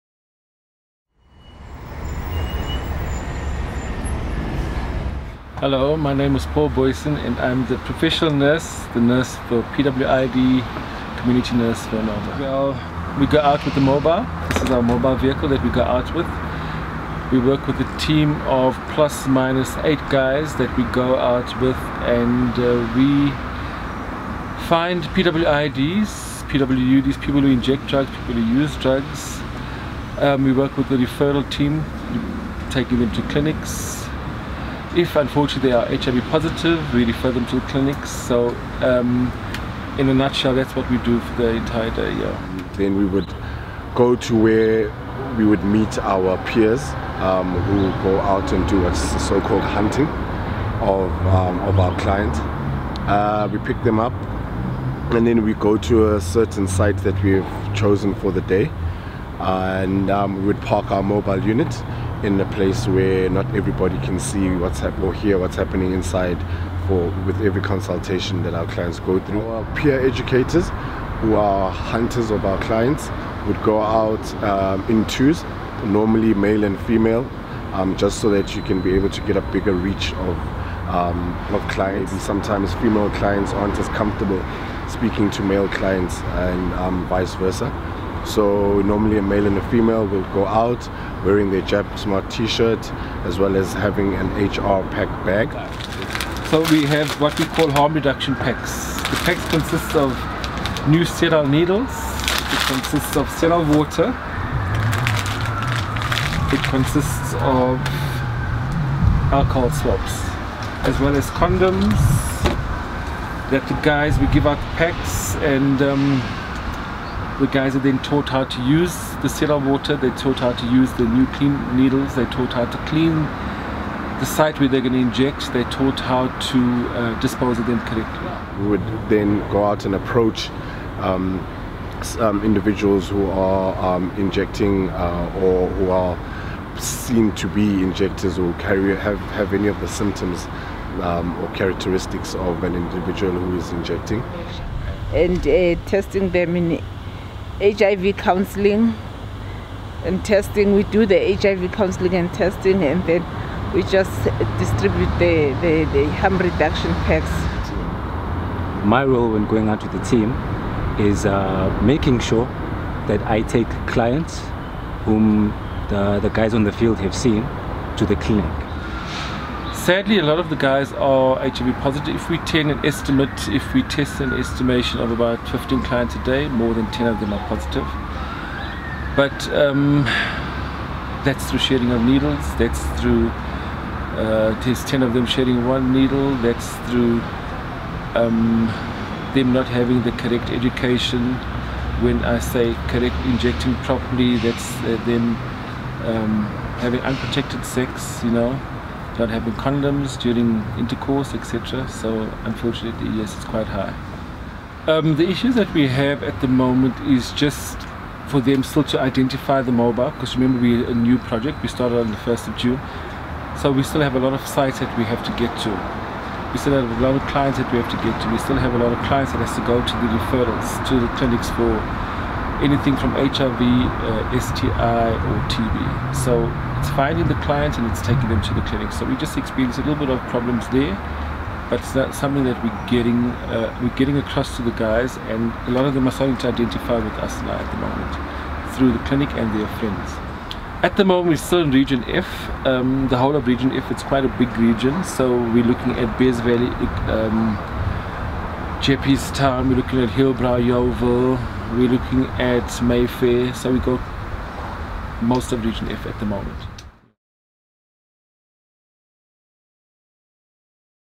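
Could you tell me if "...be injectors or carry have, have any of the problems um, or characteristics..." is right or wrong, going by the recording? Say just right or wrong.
wrong.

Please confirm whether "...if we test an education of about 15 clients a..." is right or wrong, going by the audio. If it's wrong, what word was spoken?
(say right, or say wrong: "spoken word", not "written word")
wrong: "estimation", not "education".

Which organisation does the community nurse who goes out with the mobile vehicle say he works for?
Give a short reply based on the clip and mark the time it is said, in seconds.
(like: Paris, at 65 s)
Anova, at 11 s.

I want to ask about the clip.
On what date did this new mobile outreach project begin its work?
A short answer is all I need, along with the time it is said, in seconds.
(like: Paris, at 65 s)
1 June, at 212 s.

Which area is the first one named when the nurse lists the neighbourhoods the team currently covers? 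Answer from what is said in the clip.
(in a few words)
Bez Valley.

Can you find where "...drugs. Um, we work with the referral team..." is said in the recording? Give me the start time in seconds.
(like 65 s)
28 s.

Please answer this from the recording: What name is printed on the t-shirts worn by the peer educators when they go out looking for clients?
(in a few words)
Jab Smart.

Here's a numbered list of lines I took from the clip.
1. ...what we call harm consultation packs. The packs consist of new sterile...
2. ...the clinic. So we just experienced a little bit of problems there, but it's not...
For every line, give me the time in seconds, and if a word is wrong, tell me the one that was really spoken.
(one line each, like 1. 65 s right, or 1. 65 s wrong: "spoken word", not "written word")
1. 97 s wrong: "reduction", not "consultation"
2. 228 s right.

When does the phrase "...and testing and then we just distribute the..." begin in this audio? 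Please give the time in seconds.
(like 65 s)
152 s.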